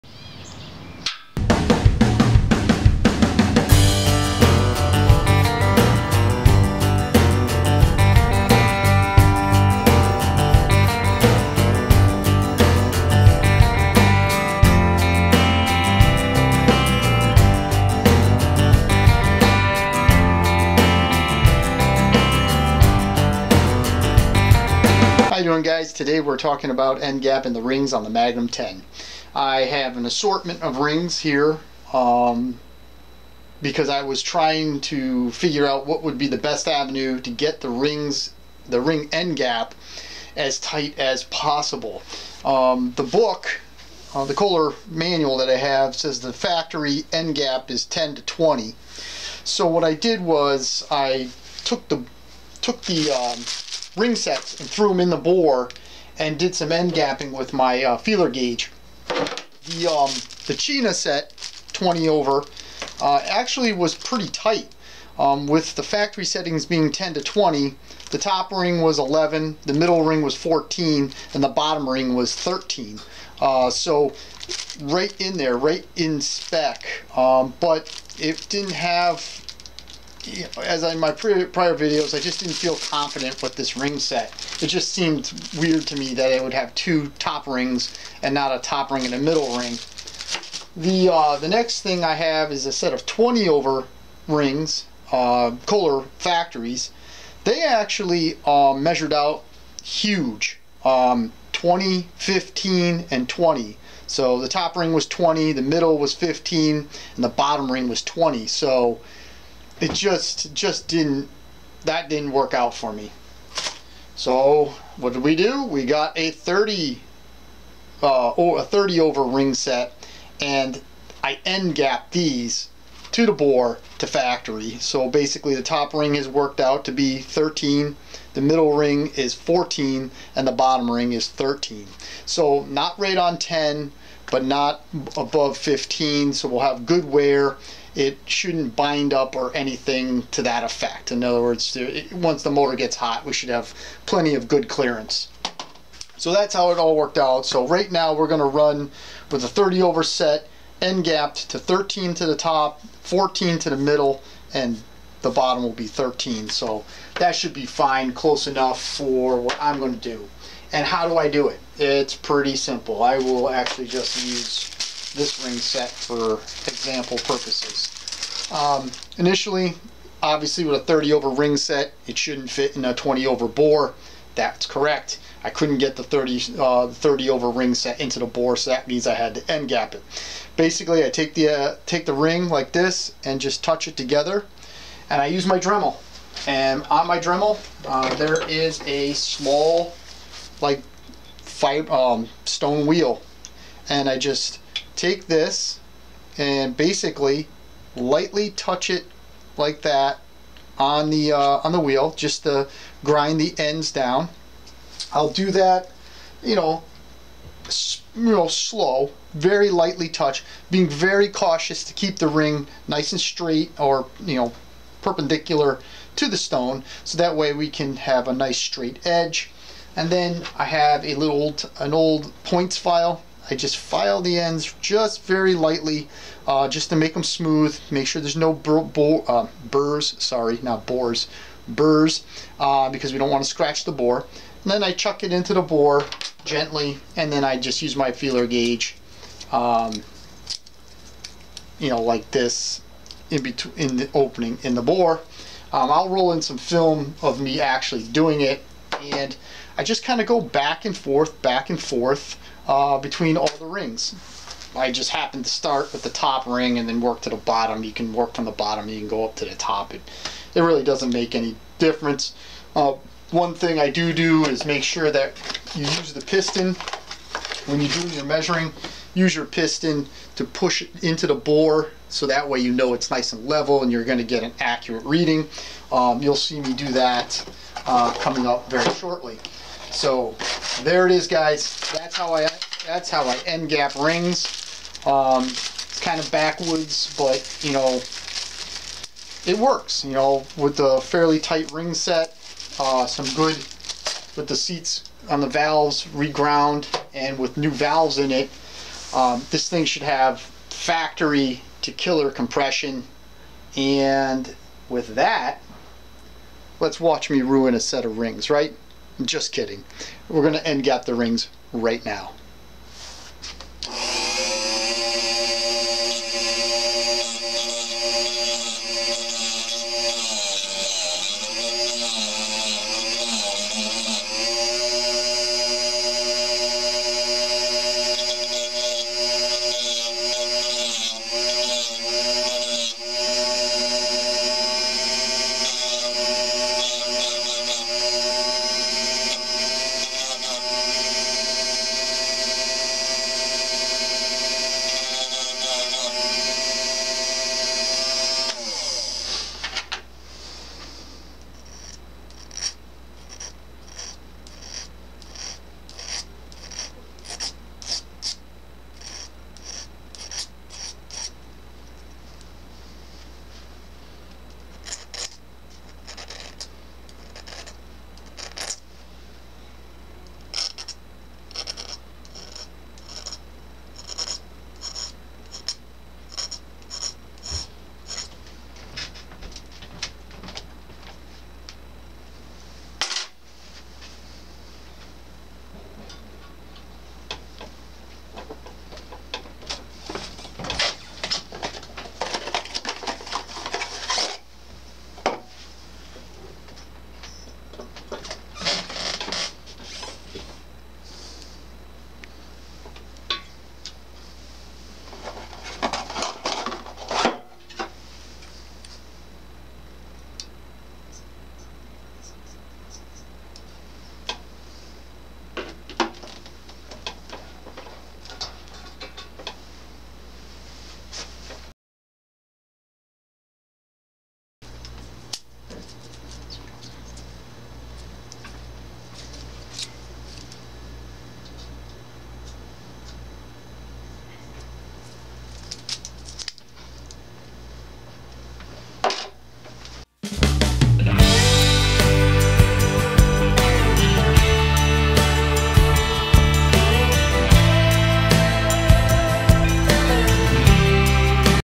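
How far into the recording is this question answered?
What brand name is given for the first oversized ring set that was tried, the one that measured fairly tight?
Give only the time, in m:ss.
1:00.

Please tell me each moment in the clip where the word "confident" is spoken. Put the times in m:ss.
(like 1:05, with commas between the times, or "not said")
1:22.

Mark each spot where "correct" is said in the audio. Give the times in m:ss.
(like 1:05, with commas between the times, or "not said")
2:54.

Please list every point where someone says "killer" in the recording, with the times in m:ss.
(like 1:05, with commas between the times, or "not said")
5:01.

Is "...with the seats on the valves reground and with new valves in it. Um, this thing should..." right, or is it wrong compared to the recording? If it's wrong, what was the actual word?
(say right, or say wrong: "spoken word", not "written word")
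right.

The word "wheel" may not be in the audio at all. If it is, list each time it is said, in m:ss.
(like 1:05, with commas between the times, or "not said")
3:12, 3:21.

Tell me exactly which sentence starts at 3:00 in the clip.
Basically, I take the, uh, take the ring like this and just touch it together, and I use my Dremel.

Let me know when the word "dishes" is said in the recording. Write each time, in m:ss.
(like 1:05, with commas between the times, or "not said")
not said.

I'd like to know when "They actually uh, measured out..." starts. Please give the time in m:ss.
1:37.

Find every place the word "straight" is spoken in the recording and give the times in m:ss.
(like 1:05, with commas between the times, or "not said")
3:33, 3:38.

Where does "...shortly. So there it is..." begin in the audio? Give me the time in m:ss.
4:38.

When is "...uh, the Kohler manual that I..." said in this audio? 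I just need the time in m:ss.
0:44.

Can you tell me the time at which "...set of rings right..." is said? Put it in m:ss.
5:07.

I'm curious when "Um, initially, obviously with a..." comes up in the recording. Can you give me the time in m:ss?
2:48.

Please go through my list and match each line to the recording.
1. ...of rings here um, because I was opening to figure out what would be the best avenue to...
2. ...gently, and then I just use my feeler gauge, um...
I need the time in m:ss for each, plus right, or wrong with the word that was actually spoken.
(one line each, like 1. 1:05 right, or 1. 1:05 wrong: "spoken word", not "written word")
1. 0:30 wrong: "trying", not "opening"
2. 3:56 right.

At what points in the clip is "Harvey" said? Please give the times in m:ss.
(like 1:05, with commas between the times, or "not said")
not said.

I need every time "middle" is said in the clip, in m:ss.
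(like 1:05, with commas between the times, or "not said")
1:09, 1:29, 1:45, 2:08, 2:33.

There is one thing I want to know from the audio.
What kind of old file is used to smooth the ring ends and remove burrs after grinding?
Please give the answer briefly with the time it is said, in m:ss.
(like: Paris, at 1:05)
points file, at 3:42.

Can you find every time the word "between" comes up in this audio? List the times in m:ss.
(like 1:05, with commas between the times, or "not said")
4:03, 4:12.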